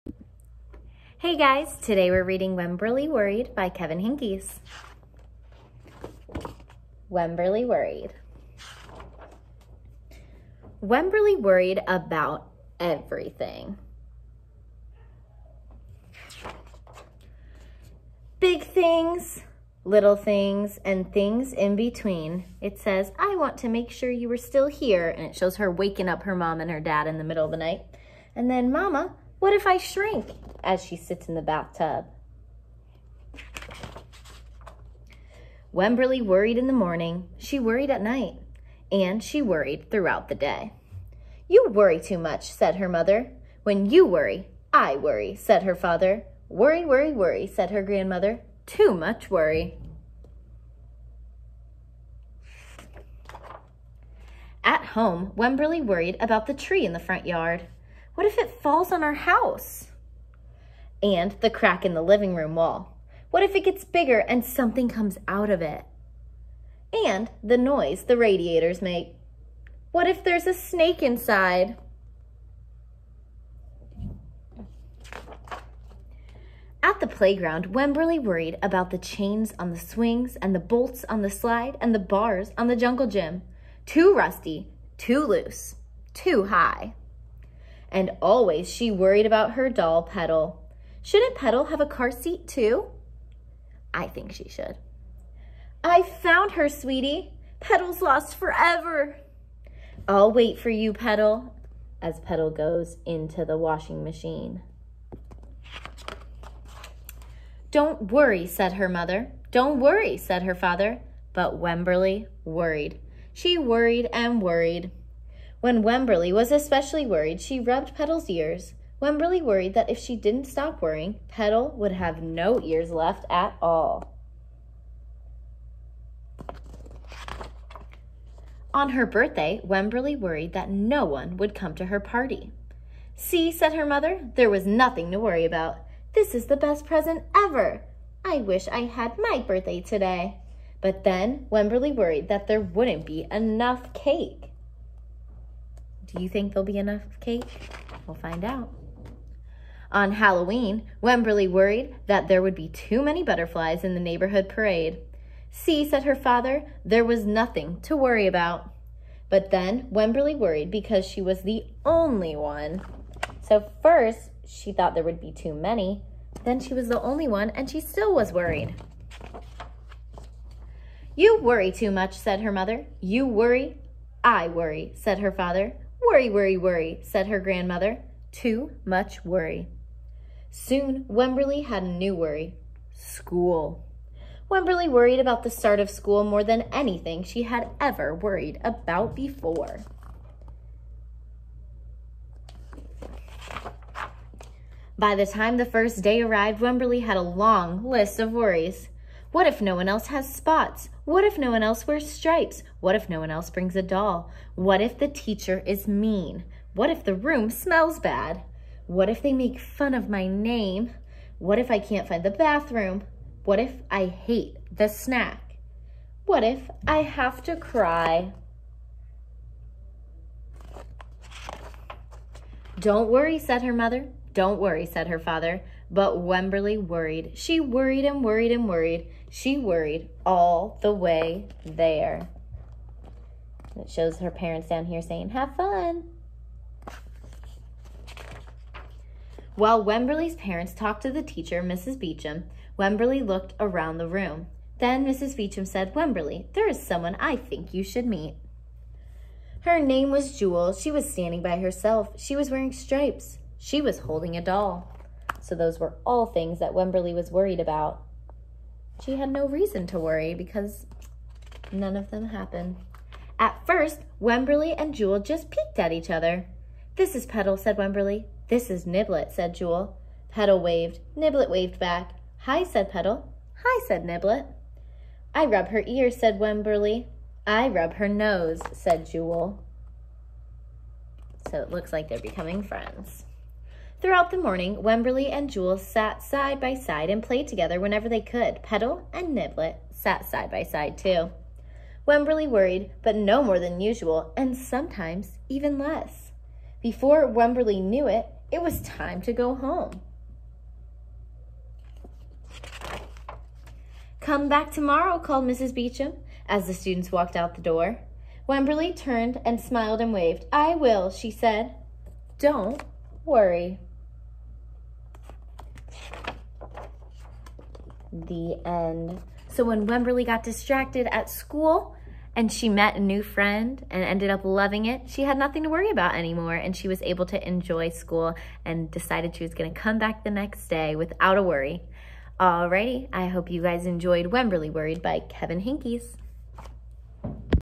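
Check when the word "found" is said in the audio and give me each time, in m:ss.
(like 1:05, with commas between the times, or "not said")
1:36.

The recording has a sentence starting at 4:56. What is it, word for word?
Before Wemberly knew it, it was time to go home.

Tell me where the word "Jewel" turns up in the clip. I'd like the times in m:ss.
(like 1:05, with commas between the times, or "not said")
4:10, 4:24, 4:29, 4:39, 4:45.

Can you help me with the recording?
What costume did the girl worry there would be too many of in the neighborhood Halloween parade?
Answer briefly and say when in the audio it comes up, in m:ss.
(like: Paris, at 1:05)
Butterflies, at 2:33.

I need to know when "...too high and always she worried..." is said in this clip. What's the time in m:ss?
1:26.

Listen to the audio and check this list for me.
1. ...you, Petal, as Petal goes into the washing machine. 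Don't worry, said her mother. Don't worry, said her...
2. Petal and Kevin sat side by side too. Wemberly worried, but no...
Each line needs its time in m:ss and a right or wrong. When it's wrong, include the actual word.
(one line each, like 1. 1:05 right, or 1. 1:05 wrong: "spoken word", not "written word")
1. 1:40 right
2. 4:48 wrong: "Niblet", not "Kevin".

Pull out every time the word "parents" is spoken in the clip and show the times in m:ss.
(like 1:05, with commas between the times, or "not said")
3:54, 4:00.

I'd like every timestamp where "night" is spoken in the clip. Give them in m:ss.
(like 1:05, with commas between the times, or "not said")
0:27, 0:38.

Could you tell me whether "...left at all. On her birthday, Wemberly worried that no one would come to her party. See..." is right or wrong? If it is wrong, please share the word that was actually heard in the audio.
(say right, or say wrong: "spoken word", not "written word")
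right.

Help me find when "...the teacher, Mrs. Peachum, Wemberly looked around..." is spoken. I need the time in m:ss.
4:01.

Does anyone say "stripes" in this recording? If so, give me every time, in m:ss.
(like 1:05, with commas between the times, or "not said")
3:22, 4:12.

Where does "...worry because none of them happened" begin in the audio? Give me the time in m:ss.
4:19.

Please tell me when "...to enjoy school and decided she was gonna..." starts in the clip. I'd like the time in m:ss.
5:27.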